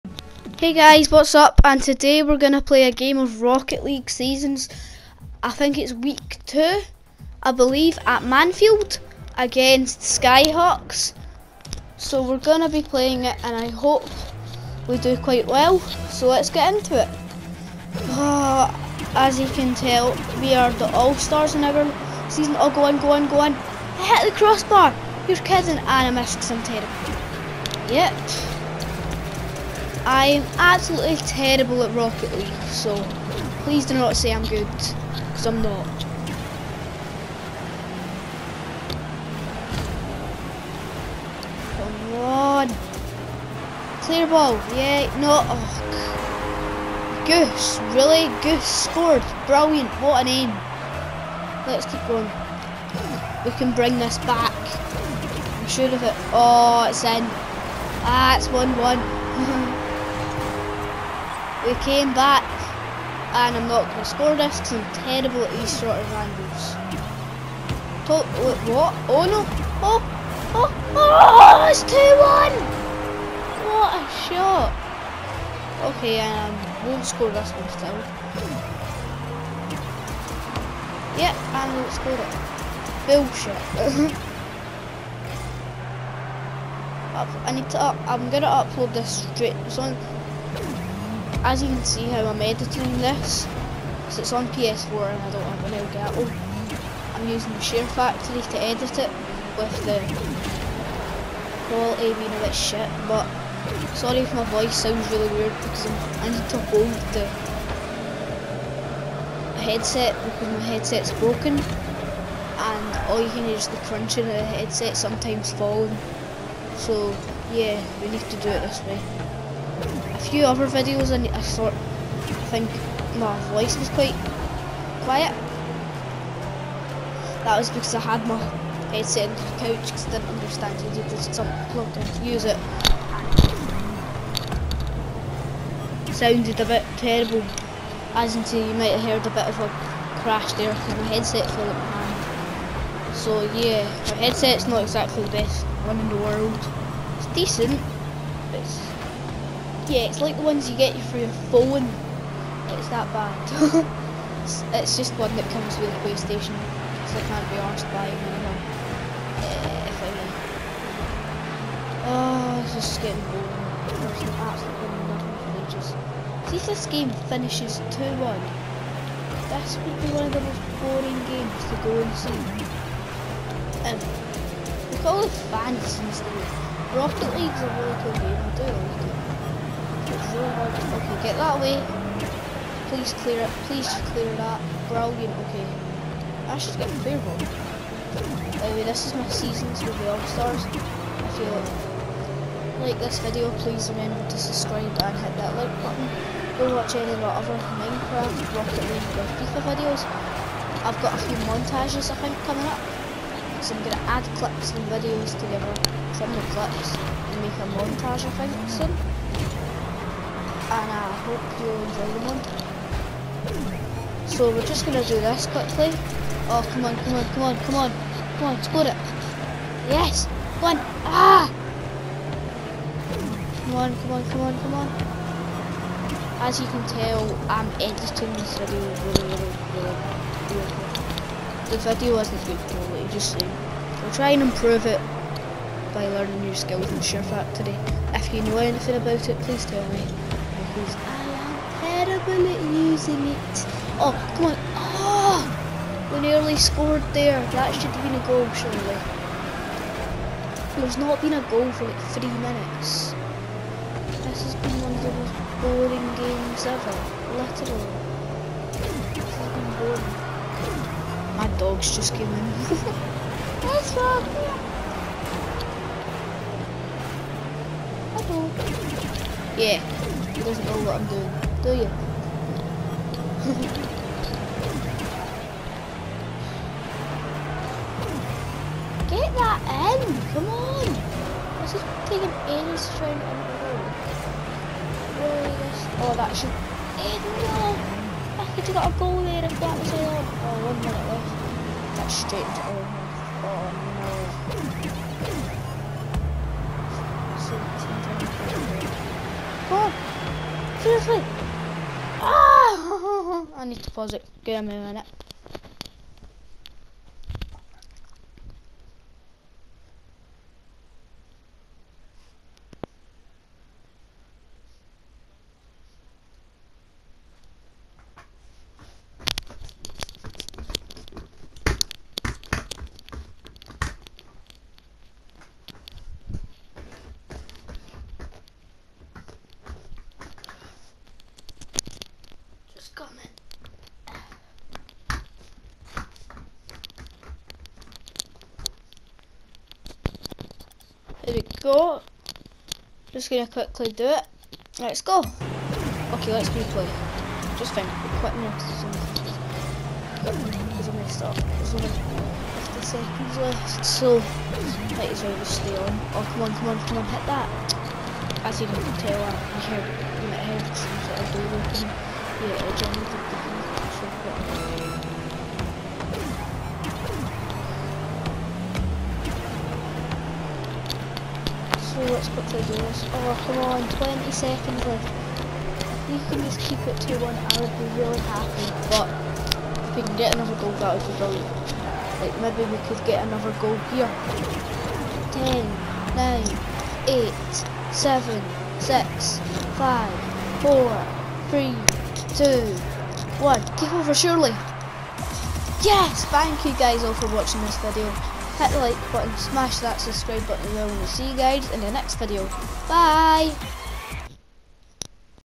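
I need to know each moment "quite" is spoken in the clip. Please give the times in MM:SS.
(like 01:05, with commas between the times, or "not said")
00:15, 02:03.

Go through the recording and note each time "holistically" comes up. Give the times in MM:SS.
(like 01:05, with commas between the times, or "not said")
not said.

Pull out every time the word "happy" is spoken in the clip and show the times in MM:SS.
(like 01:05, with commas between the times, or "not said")
06:18.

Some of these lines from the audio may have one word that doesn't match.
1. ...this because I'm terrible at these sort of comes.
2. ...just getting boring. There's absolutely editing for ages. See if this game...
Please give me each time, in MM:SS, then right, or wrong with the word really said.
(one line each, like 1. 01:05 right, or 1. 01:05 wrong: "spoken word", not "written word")
1. 01:04 wrong: "angles", not "comes"
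2. 02:42 wrong: "nothing", not "editing".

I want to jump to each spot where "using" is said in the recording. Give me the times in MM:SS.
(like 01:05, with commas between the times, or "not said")
01:37, 04:02.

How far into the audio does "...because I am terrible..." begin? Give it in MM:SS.
04:00.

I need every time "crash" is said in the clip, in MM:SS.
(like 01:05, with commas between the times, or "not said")
02:20.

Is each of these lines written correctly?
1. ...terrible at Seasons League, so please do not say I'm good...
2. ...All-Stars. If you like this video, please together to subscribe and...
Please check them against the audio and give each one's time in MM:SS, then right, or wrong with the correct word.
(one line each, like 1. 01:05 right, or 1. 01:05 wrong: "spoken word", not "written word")
1. 00:31 wrong: "Rocket", not "Seasons"
2. 03:10 wrong: "remember", not "together".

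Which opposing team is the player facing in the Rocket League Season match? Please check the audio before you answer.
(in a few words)
Skyhawks.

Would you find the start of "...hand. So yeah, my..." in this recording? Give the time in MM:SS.
02:22.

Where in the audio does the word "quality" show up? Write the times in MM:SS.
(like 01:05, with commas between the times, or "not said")
01:41, 03:52.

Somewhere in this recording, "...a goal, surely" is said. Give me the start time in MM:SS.
04:08.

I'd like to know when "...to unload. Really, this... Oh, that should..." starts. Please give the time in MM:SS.
04:43.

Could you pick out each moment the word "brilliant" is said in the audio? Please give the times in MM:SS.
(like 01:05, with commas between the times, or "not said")
00:49, 03:04, 06:21.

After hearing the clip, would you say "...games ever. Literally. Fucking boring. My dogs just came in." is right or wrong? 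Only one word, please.
right.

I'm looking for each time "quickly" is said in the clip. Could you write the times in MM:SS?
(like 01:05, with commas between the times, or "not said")
03:35, 05:43, 06:12.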